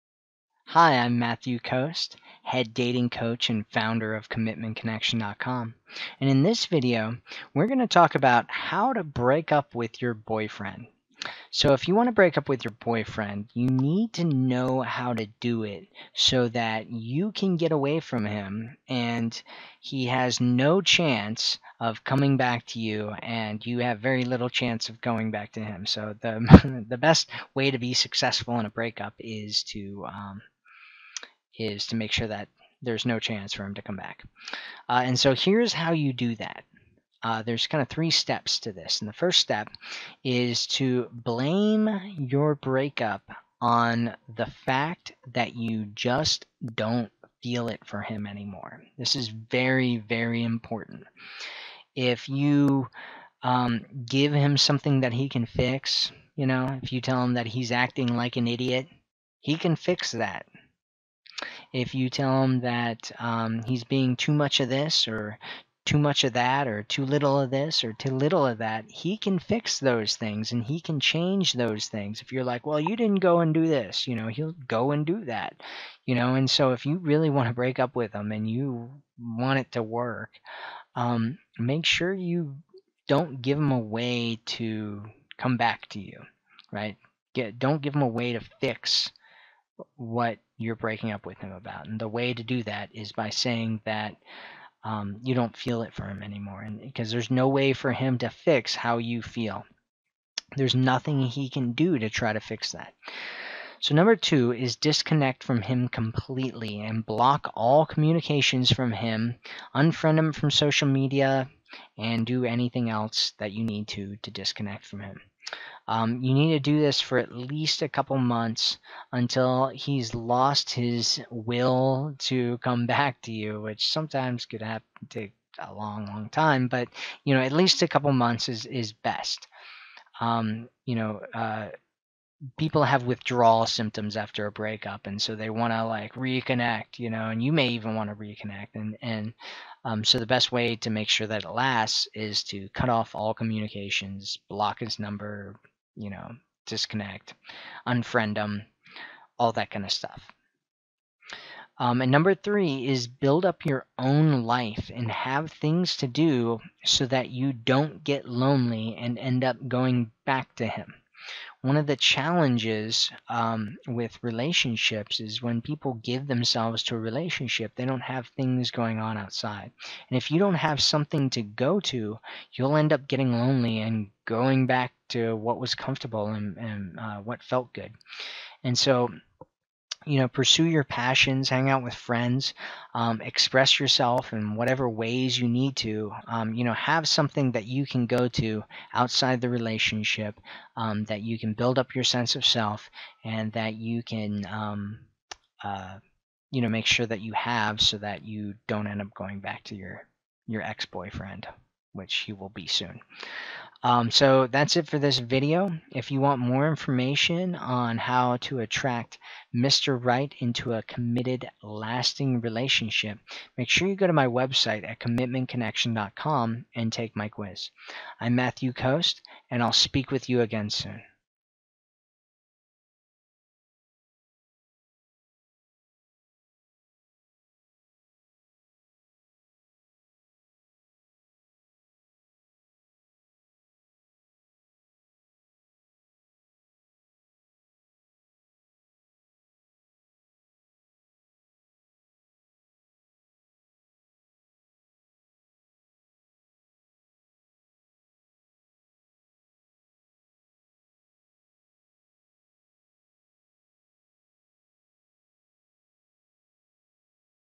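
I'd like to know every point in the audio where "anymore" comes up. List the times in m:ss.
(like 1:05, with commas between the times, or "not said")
0:48, 1:36.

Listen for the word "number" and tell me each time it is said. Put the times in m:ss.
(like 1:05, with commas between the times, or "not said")
1:43, 2:24, 2:32.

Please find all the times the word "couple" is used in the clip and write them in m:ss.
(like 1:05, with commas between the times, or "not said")
1:57, 2:07.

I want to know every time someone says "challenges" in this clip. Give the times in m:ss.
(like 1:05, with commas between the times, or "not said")
2:41.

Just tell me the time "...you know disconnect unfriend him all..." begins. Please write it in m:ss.
2:25.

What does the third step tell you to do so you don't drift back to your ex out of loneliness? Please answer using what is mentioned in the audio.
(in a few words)
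Build up your own life.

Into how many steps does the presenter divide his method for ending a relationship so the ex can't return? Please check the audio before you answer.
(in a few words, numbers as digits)
3.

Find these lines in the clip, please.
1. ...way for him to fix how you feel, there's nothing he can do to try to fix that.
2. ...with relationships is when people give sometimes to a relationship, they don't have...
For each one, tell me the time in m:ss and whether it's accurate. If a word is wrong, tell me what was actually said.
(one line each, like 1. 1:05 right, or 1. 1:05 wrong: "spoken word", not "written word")
1. 1:37 right
2. 2:43 wrong: "themselves", not "sometimes".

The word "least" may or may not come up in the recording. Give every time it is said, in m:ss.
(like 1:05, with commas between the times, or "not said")
1:57, 2:07.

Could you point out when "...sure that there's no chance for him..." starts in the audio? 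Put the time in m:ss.
0:32.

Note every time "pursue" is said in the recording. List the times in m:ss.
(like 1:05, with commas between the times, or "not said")
3:00.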